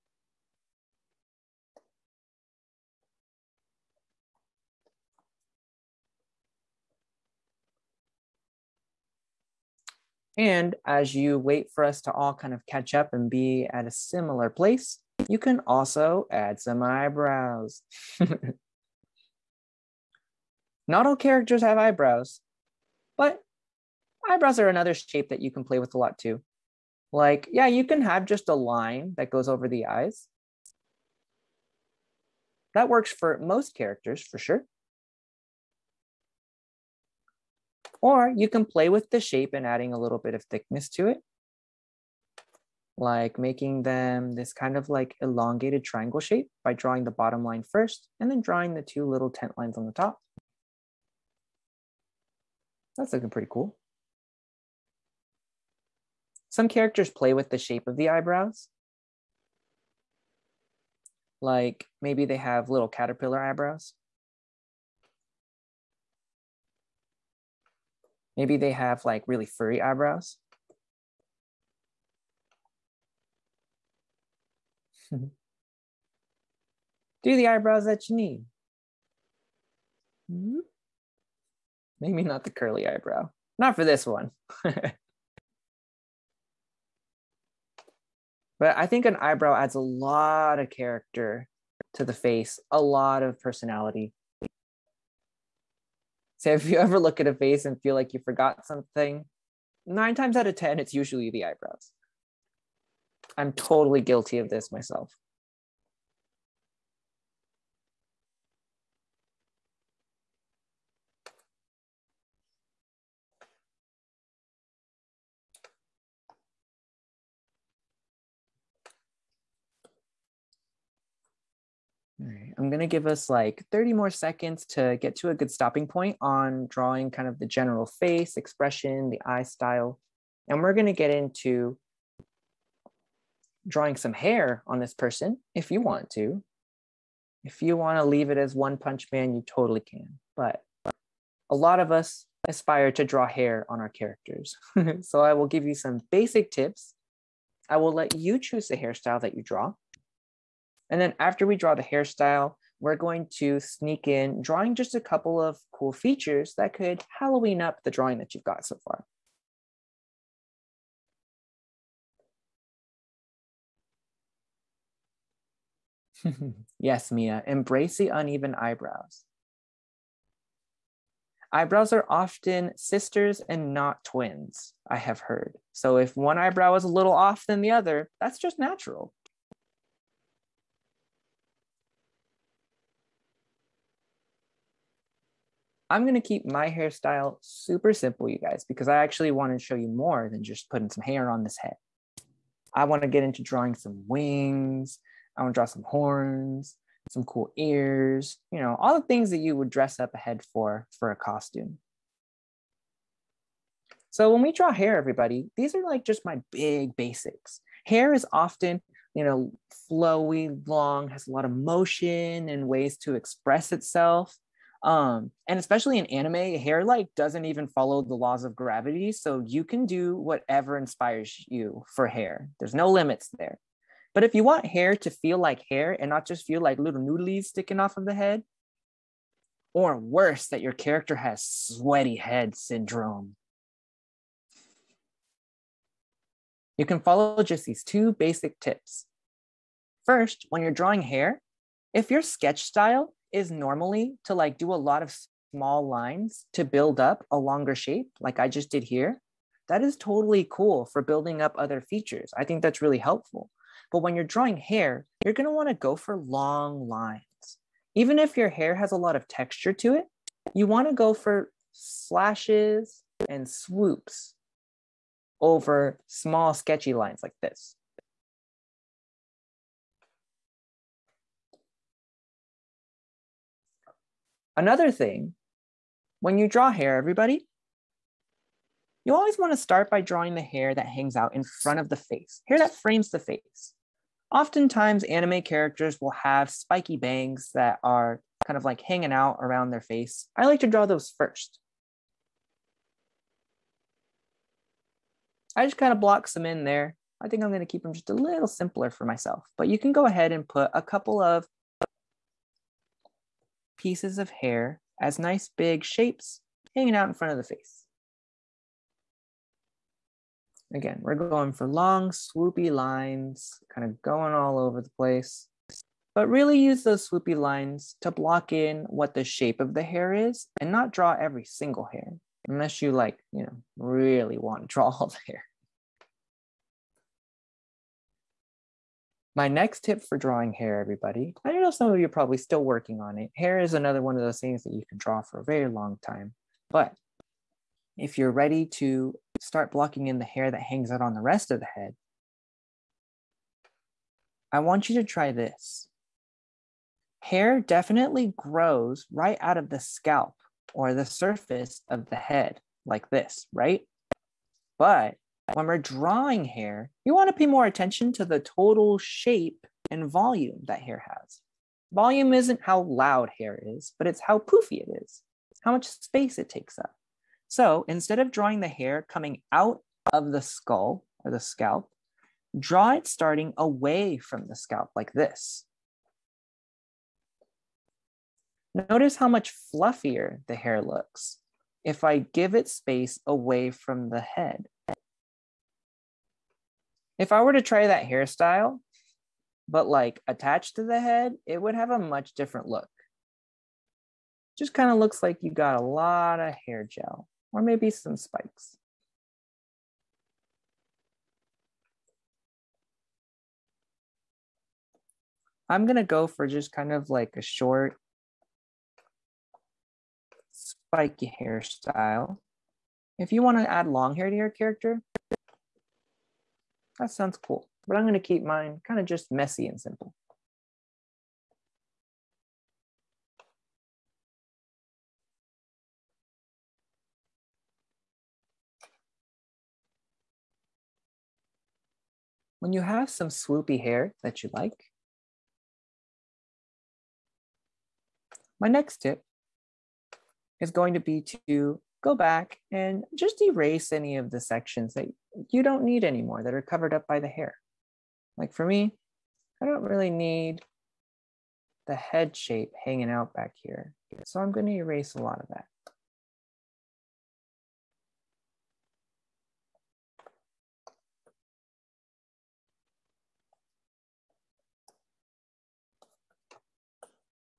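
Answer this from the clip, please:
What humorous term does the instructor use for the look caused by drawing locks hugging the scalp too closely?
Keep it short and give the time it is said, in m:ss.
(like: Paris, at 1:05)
sweaty head syndrome, at 3:51.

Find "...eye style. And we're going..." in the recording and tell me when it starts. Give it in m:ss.
2:09.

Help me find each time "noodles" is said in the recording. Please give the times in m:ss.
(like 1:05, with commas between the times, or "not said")
3:47.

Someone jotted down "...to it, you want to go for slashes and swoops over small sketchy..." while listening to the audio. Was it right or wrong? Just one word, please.
right.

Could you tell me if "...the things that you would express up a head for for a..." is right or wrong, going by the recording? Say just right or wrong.
wrong.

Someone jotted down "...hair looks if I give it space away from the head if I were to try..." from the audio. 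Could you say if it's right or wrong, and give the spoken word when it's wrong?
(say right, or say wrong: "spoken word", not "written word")
right.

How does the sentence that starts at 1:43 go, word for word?
I'm totally guilty of this myself.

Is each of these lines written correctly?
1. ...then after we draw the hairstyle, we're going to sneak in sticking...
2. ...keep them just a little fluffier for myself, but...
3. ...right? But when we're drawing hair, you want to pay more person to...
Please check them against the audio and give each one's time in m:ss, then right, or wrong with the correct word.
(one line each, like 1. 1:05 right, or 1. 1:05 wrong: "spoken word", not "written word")
1. 2:31 wrong: "drawing", not "sticking"
2. 4:57 wrong: "simpler", not "fluffier"
3. 5:53 wrong: "attention", not "person".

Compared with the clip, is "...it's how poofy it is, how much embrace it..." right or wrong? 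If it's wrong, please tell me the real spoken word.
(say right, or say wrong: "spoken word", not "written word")
wrong: "space", not "embrace".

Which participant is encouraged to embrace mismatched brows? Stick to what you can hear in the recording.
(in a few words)
Mia.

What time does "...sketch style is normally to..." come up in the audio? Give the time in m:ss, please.
4:02.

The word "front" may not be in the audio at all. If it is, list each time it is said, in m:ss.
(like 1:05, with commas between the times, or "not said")
4:41, 5:07.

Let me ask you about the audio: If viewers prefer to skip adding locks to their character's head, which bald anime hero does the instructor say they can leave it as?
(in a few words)
One Punch Man.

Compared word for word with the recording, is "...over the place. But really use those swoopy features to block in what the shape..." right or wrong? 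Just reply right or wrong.
wrong.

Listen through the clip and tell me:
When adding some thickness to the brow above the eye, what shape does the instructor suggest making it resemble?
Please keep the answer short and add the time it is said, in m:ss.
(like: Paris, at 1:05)
elongated triangle, at 0:45.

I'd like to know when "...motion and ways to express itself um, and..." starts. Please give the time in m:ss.
3:31.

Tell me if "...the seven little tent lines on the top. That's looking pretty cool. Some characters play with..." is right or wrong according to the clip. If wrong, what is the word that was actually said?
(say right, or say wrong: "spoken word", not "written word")
wrong: "two", not "seven".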